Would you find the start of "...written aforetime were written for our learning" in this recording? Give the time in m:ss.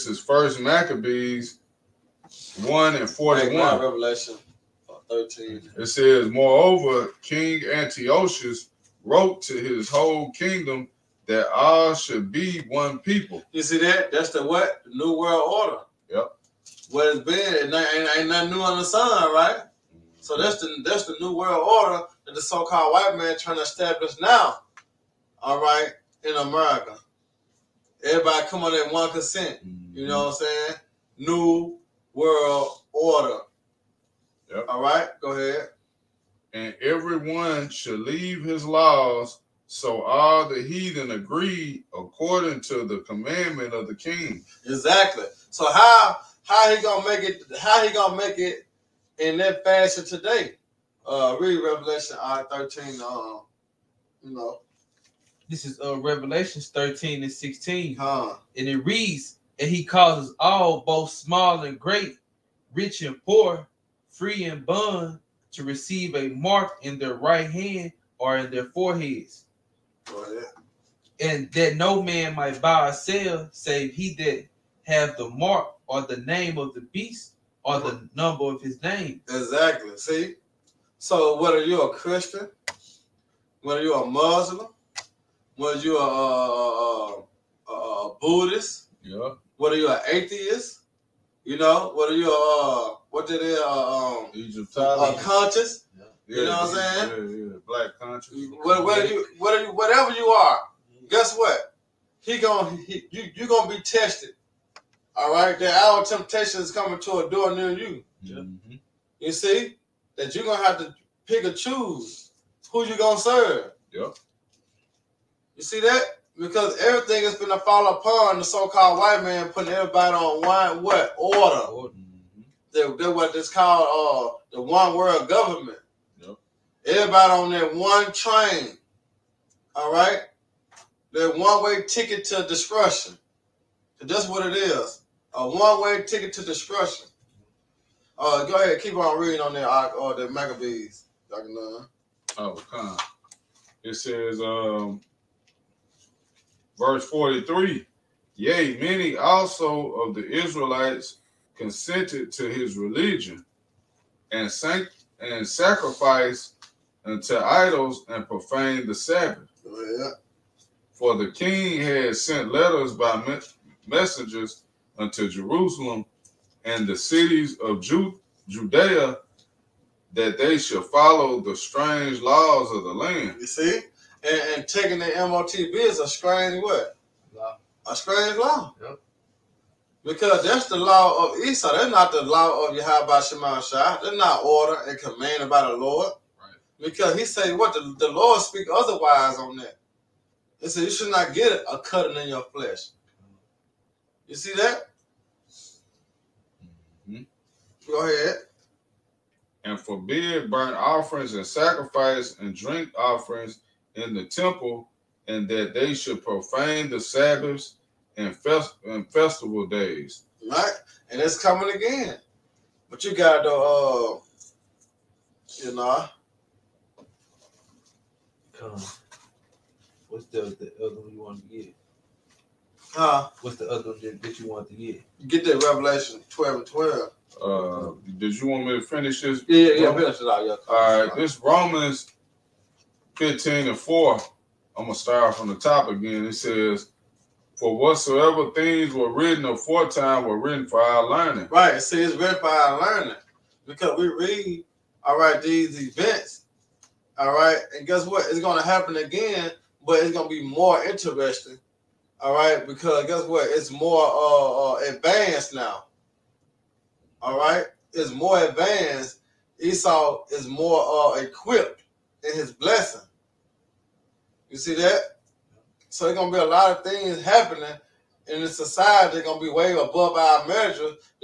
3:59.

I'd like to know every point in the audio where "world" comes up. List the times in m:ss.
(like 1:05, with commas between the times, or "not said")
0:15, 0:21, 0:32, 2:04.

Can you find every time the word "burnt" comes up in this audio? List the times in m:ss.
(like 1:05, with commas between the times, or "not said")
3:20.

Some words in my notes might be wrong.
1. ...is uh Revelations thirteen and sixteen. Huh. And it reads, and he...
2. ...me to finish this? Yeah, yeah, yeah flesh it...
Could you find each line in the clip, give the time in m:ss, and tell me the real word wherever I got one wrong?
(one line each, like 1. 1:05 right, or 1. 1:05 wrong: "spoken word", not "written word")
1. 0:55 right
2. 3:48 wrong: "finish", not "flesh".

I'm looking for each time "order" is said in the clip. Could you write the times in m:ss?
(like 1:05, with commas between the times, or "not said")
0:15, 0:21, 0:32, 2:01, 3:04.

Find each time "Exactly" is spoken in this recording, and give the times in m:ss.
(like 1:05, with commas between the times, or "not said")
0:44, 1:19.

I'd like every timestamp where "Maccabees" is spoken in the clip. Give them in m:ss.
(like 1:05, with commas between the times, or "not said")
0:00, 2:20.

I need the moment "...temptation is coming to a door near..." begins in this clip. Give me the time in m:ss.
1:46.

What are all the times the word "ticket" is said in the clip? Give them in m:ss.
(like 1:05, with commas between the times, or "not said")
2:11, 2:16.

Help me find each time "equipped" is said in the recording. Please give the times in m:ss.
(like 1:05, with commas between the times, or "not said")
4:21.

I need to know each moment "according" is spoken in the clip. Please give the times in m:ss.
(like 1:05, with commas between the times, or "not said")
0:41.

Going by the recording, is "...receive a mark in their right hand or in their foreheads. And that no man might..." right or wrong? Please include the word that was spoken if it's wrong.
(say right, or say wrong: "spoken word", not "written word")
right.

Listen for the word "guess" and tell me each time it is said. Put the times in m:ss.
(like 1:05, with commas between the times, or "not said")
1:41, 4:07, 4:13.